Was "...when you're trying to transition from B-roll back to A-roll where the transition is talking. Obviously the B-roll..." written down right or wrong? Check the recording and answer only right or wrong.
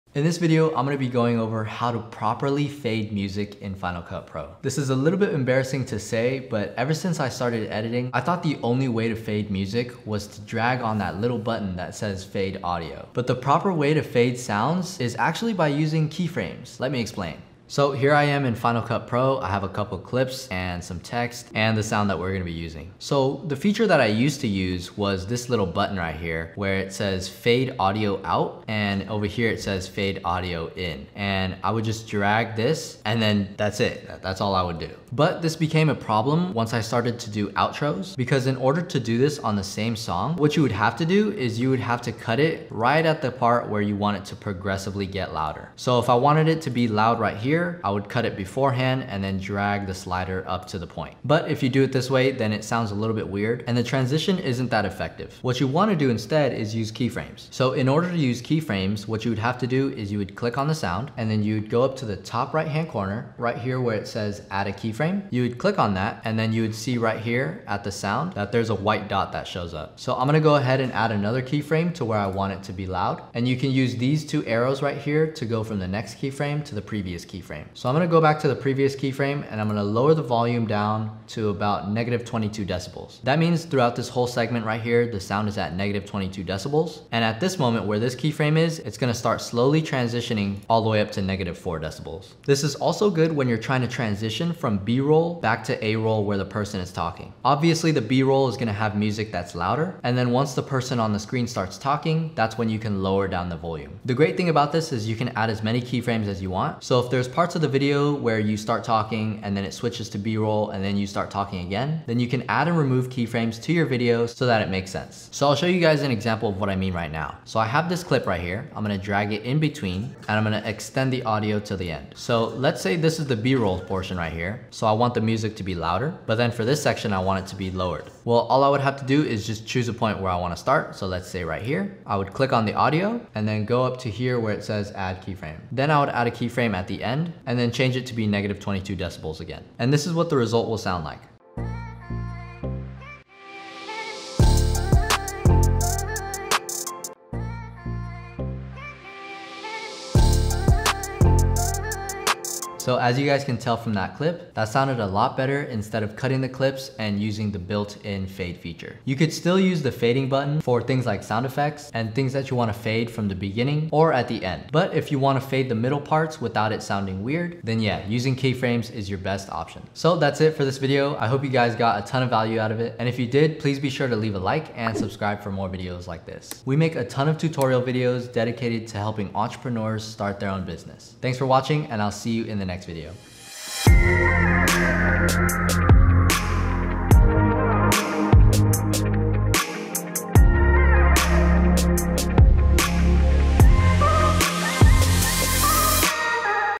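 wrong.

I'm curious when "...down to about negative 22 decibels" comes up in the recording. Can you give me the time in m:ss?
1:20.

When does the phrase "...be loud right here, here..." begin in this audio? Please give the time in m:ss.
0:46.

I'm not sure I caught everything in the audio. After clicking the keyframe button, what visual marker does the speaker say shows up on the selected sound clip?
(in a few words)
A white dot.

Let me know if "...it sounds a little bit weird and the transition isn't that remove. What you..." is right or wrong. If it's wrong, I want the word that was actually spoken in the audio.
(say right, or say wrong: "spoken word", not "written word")
wrong: "effective", not "remove".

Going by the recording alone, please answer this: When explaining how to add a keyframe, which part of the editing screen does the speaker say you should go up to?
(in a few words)
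Top right hand corner.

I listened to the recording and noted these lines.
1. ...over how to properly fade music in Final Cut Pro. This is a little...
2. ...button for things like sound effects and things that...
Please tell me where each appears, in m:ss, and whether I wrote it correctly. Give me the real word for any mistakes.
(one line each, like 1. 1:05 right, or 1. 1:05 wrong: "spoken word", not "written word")
1. 0:01 right
2. 2:40 right.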